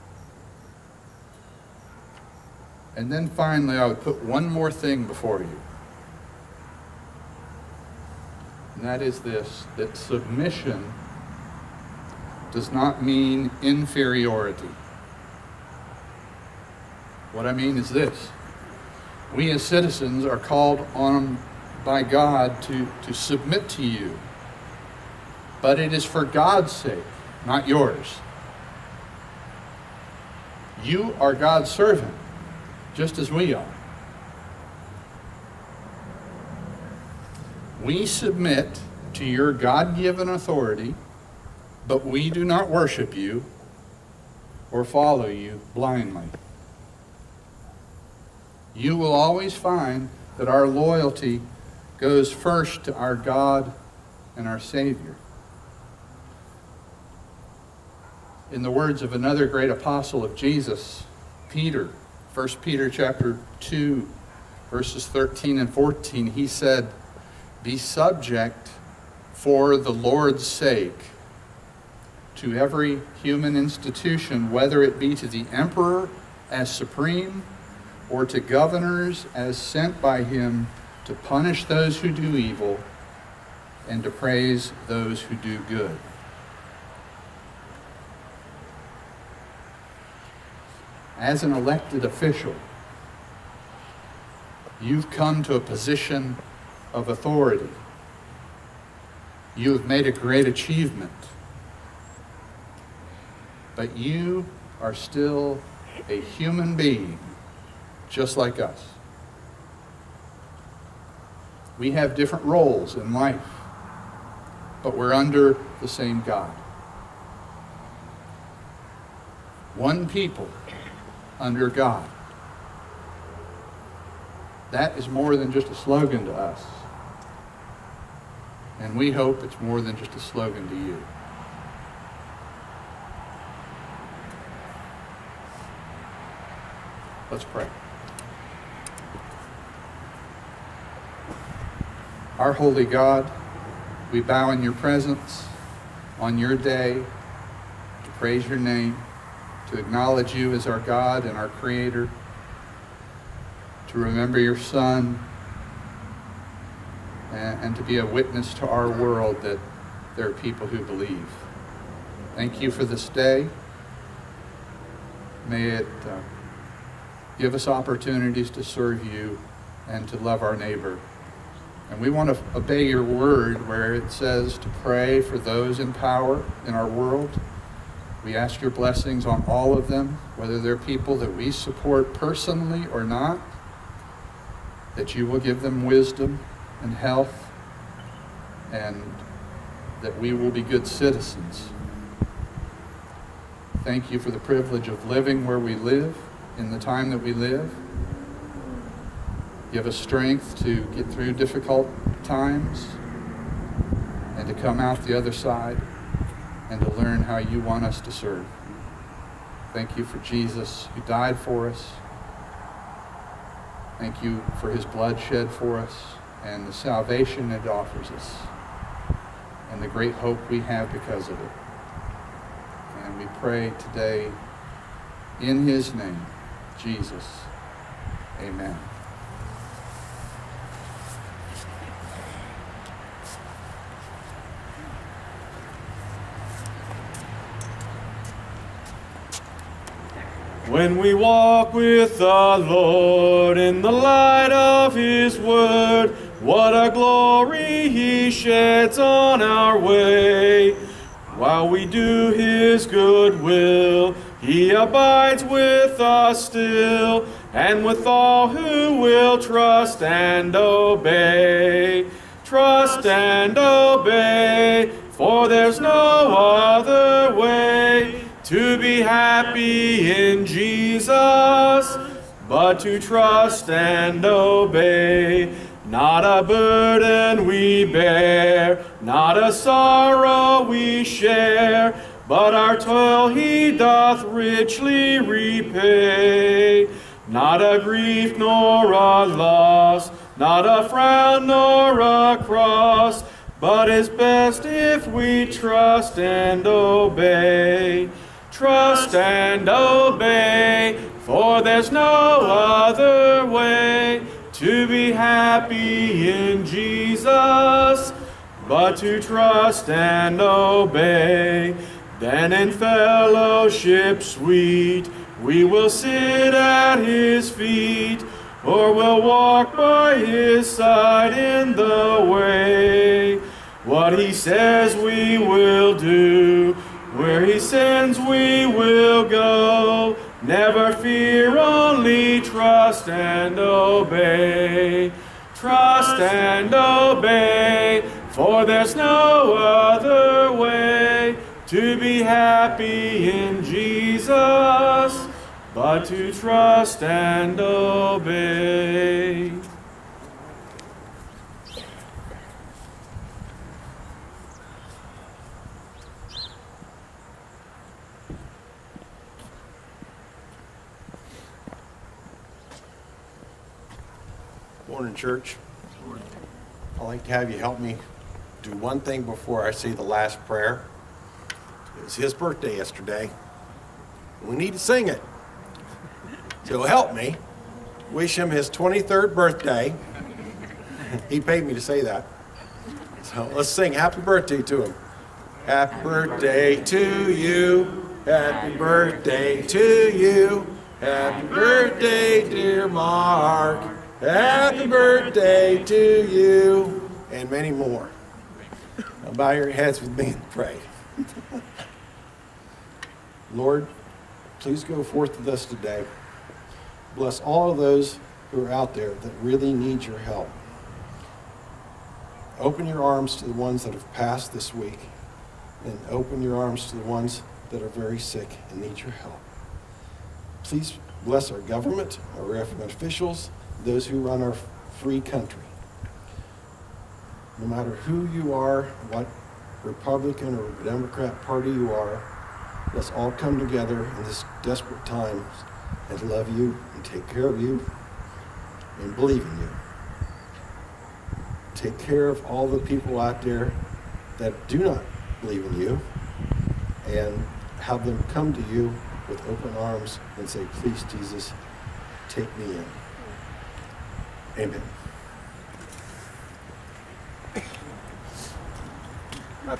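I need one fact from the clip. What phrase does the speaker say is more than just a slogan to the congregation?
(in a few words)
One people under God.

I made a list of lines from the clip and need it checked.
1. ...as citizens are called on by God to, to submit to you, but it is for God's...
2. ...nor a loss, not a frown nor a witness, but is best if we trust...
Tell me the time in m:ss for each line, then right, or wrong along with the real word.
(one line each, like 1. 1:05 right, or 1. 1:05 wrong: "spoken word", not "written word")
1. 0:19 right
2. 4:48 wrong: "cross", not "witness".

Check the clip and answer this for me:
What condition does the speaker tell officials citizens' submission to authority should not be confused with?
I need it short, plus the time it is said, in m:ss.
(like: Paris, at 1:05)
inferiority, at 0:13.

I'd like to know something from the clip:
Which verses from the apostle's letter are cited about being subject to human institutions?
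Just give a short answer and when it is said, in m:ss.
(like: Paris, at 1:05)
13 and 14, at 1:05.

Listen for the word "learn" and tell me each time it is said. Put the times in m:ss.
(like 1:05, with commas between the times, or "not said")
3:26.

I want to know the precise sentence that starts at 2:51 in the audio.
And we want to obey your word where it says to pray for those in power in our world.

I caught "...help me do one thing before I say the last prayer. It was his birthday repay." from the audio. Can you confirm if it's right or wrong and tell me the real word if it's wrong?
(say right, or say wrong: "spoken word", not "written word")
wrong: "yesterday", not "repay".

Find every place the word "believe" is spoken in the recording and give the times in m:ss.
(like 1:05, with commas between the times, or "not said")
2:40, 7:19, 7:25.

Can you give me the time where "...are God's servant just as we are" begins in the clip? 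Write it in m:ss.
0:31.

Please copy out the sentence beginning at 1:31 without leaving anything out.
as an elected official, you've come to a position of authority.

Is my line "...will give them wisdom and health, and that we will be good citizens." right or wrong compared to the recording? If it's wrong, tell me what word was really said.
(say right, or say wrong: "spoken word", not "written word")
right.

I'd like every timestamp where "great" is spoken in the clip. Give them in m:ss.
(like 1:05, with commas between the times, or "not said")
0:59, 1:40, 3:39.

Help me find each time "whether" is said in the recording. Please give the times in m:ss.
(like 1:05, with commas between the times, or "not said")
1:14, 3:00.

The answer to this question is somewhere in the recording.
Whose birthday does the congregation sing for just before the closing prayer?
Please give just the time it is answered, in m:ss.
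6:32.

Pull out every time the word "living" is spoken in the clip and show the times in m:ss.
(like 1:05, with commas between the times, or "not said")
3:15.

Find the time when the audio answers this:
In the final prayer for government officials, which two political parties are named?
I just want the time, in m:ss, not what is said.
7:09.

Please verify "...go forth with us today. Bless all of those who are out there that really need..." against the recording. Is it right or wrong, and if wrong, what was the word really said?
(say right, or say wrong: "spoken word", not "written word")
right.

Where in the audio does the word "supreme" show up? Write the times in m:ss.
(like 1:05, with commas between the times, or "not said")
1:16.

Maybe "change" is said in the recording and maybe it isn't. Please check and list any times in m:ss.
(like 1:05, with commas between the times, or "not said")
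not said.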